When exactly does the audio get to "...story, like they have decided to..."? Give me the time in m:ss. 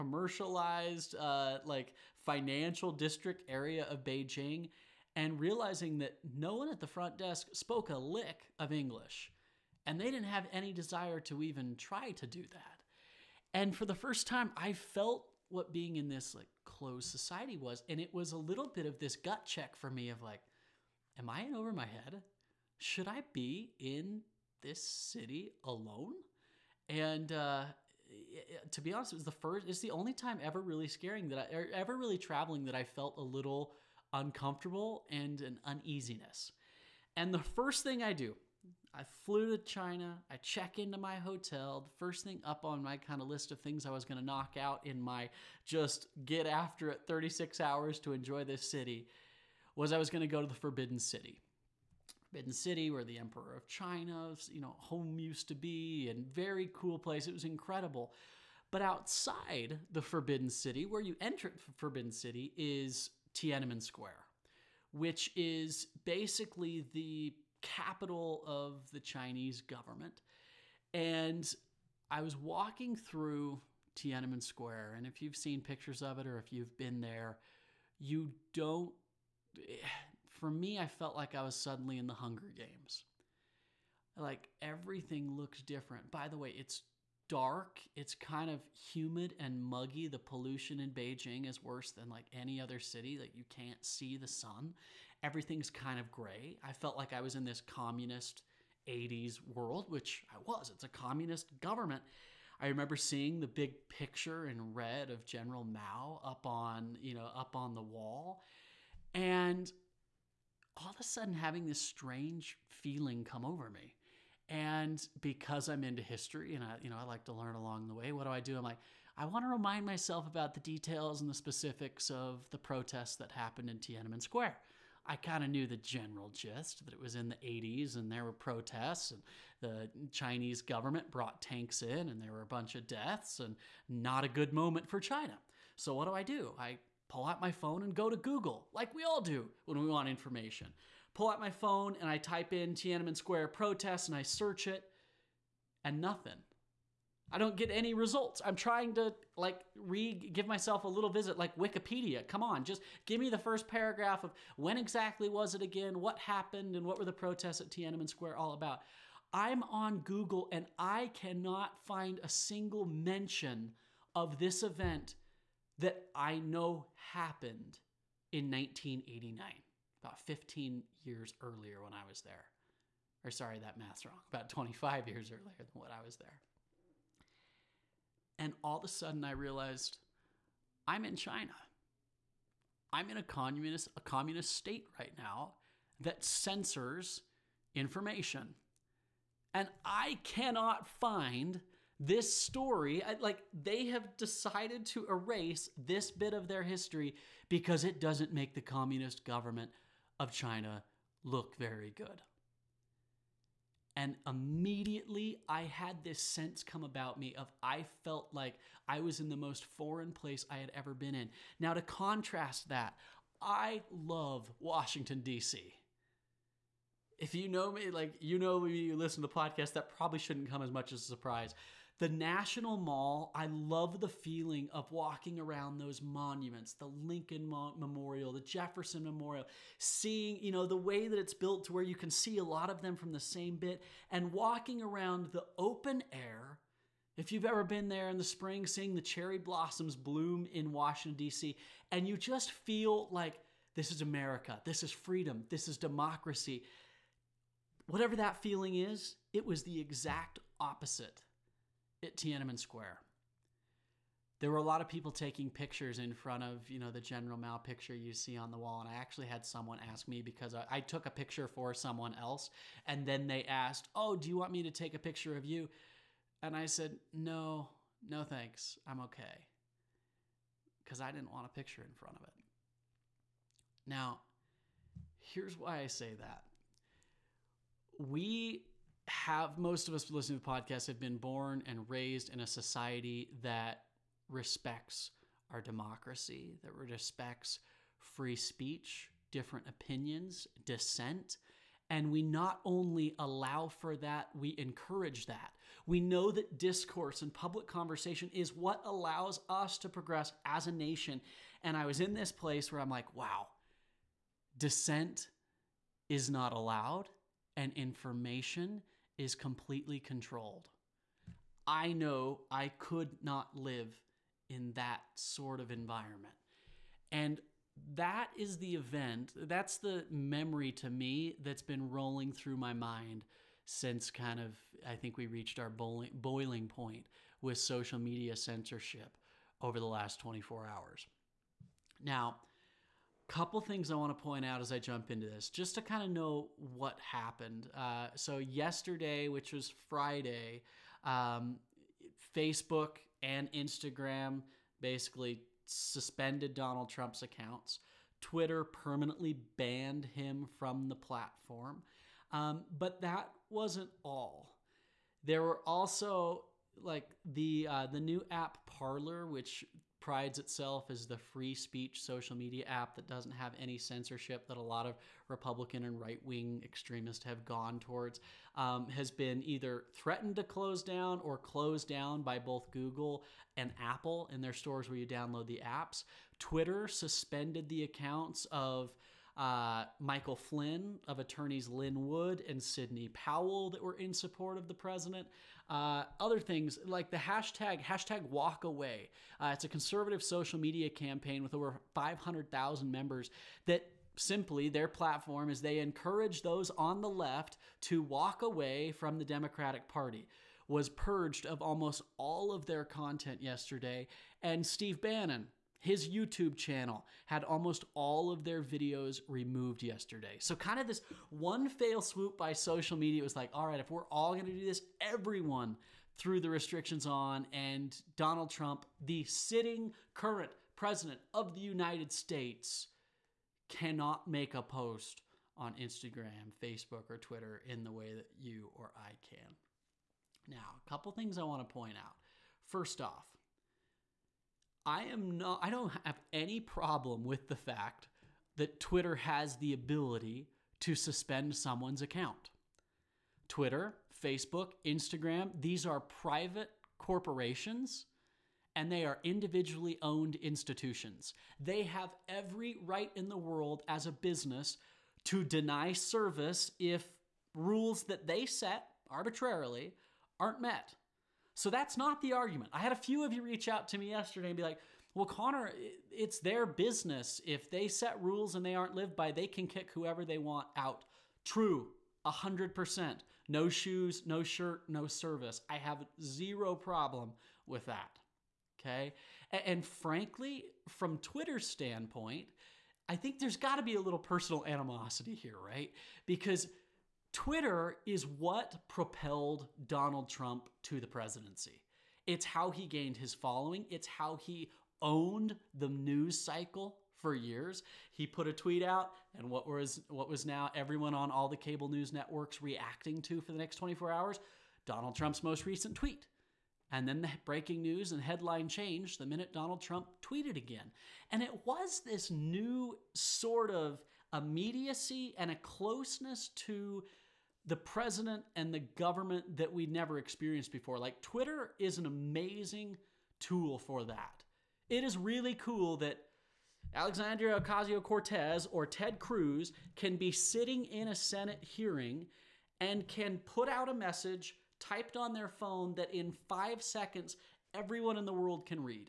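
3:12.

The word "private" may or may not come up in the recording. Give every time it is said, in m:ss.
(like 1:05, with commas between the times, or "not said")
7:25.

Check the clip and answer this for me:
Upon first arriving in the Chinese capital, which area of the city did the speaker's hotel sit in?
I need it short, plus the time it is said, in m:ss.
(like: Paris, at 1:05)
Financial district, at 0:02.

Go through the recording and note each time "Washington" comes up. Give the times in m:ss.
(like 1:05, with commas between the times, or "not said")
3:34, 4:00.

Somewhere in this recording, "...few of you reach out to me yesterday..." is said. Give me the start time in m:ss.
7:42.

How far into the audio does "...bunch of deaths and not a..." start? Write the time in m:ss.
2:12.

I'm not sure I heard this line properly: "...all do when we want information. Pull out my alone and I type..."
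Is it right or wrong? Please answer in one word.
wrong.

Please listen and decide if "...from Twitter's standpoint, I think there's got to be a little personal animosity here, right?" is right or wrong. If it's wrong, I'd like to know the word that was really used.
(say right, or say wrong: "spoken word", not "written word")
right.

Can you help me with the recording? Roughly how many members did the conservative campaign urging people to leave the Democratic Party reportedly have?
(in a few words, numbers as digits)
500,000.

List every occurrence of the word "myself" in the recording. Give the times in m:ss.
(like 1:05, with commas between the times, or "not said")
1:59, 2:30.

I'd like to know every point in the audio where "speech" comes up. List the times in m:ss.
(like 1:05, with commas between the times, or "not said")
4:48, 6:01.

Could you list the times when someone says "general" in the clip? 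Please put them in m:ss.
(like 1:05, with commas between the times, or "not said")
1:45, 2:05, 4:17.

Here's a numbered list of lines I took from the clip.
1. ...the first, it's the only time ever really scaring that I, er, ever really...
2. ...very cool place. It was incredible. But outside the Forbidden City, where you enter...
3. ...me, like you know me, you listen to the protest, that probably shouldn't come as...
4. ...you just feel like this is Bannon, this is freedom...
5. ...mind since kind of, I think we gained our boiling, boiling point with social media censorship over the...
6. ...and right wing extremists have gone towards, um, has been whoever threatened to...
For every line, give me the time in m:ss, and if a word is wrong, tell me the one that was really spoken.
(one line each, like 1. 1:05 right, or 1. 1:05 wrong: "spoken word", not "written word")
1. 0:29 right
2. 0:56 right
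3. 3:37 wrong: "podcast", not "protest"
4. 4:02 wrong: "America", not "Bannon"
5. 5:22 wrong: "reached", not "gained"
6. 6:05 wrong: "either", not "whoever".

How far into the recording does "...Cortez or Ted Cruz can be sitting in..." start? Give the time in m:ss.
8:48.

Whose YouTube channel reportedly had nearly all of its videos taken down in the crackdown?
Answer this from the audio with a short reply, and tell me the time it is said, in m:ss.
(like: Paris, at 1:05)
Steve Bannon, at 6:44.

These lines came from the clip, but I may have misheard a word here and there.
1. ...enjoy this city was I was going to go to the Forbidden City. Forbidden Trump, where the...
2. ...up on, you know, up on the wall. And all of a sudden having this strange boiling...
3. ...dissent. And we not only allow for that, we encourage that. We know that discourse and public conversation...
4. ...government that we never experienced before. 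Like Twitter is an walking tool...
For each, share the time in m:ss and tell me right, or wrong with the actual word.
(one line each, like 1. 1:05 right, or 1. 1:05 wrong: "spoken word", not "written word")
1. 0:48 wrong: "City", not "Trump"
2. 1:46 wrong: "feeling", not "boiling"
3. 4:50 right
4. 8:38 wrong: "amazing", not "walking".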